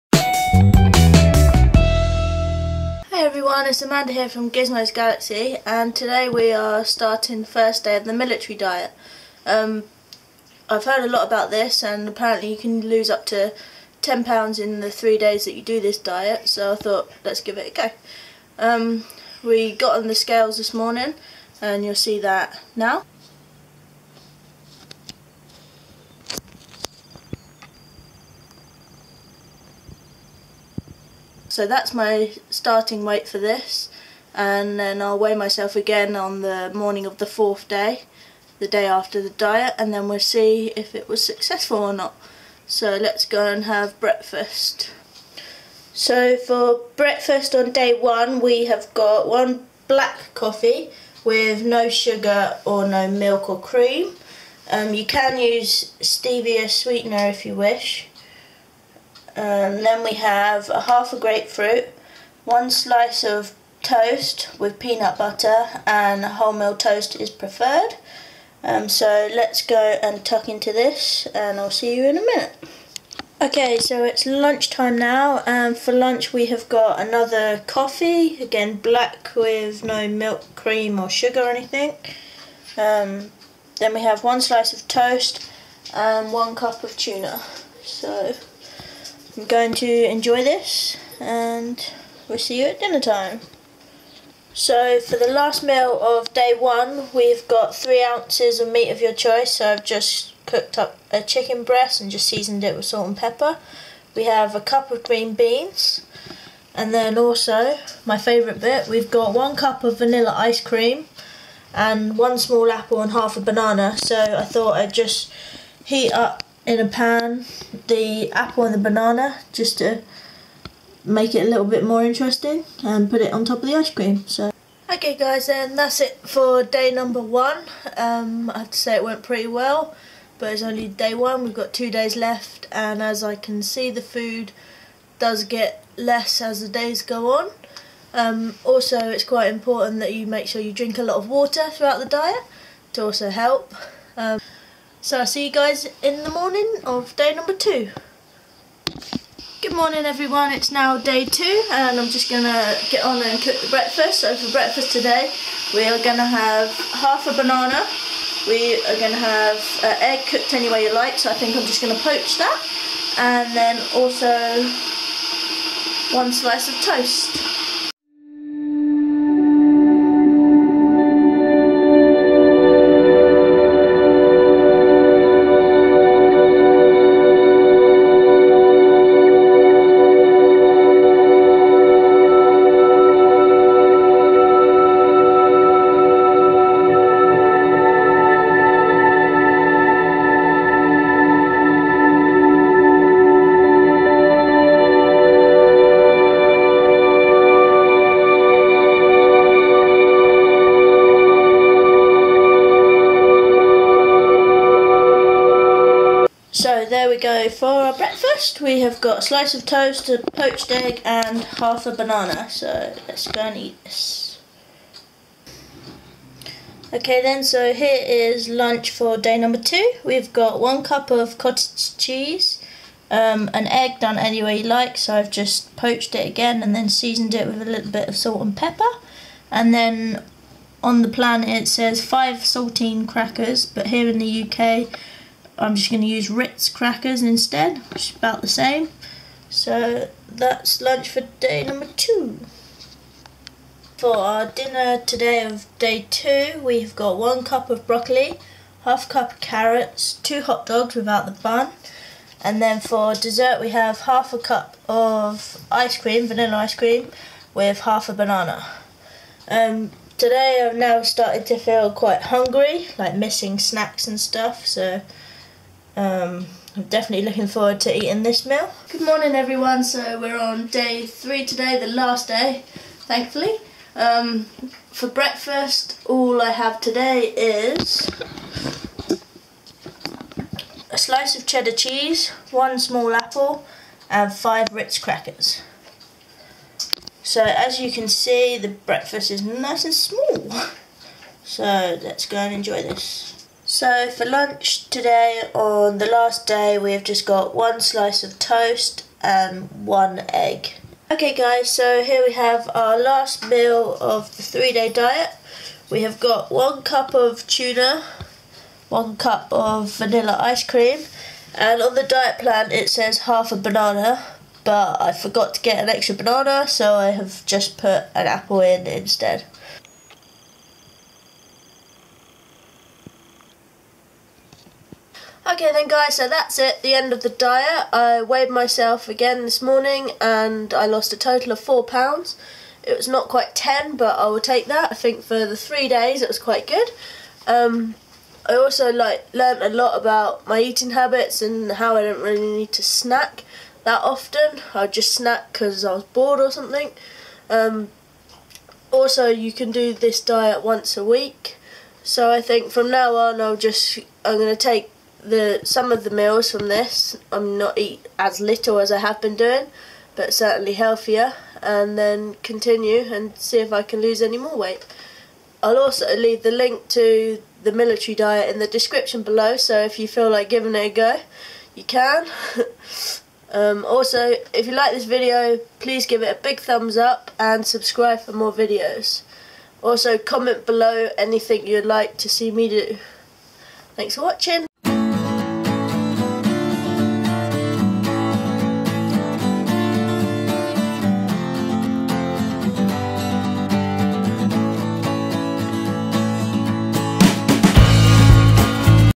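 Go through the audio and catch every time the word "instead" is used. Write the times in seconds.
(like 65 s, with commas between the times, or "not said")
237 s, 318 s.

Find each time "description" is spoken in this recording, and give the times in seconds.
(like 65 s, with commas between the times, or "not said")
368 s.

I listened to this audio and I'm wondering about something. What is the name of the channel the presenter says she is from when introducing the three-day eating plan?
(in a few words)
Gizmos Galaxy.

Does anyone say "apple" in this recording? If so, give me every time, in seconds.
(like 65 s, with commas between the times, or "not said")
112 s, 118 s, 283 s, 318 s.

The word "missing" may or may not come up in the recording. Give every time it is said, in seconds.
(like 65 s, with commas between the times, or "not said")
263 s.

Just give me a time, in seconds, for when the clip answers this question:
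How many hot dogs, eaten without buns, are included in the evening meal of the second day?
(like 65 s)
250 s.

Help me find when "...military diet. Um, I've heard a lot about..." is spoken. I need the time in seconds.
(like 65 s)
8 s.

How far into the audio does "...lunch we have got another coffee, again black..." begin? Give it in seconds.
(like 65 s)
75 s.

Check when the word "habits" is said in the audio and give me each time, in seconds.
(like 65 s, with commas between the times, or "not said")
340 s.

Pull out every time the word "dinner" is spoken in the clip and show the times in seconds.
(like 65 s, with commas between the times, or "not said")
92 s, 244 s.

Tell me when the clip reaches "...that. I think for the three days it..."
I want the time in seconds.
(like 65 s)
334 s.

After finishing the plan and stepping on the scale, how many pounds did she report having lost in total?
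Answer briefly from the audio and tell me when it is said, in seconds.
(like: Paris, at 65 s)
4 pounds, at 331 s.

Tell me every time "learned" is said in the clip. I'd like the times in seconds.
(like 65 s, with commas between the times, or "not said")
339 s.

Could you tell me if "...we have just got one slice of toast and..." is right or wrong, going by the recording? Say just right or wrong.
right.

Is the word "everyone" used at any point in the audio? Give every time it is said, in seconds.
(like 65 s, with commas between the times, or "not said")
3 s, 150 s, 269 s.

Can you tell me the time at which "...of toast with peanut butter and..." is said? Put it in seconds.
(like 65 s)
63 s.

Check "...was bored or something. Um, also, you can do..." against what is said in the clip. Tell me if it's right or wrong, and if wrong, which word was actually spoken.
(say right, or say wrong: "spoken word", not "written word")
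right.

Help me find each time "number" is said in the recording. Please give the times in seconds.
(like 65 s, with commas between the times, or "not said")
126 s, 147 s, 219 s, 241 s.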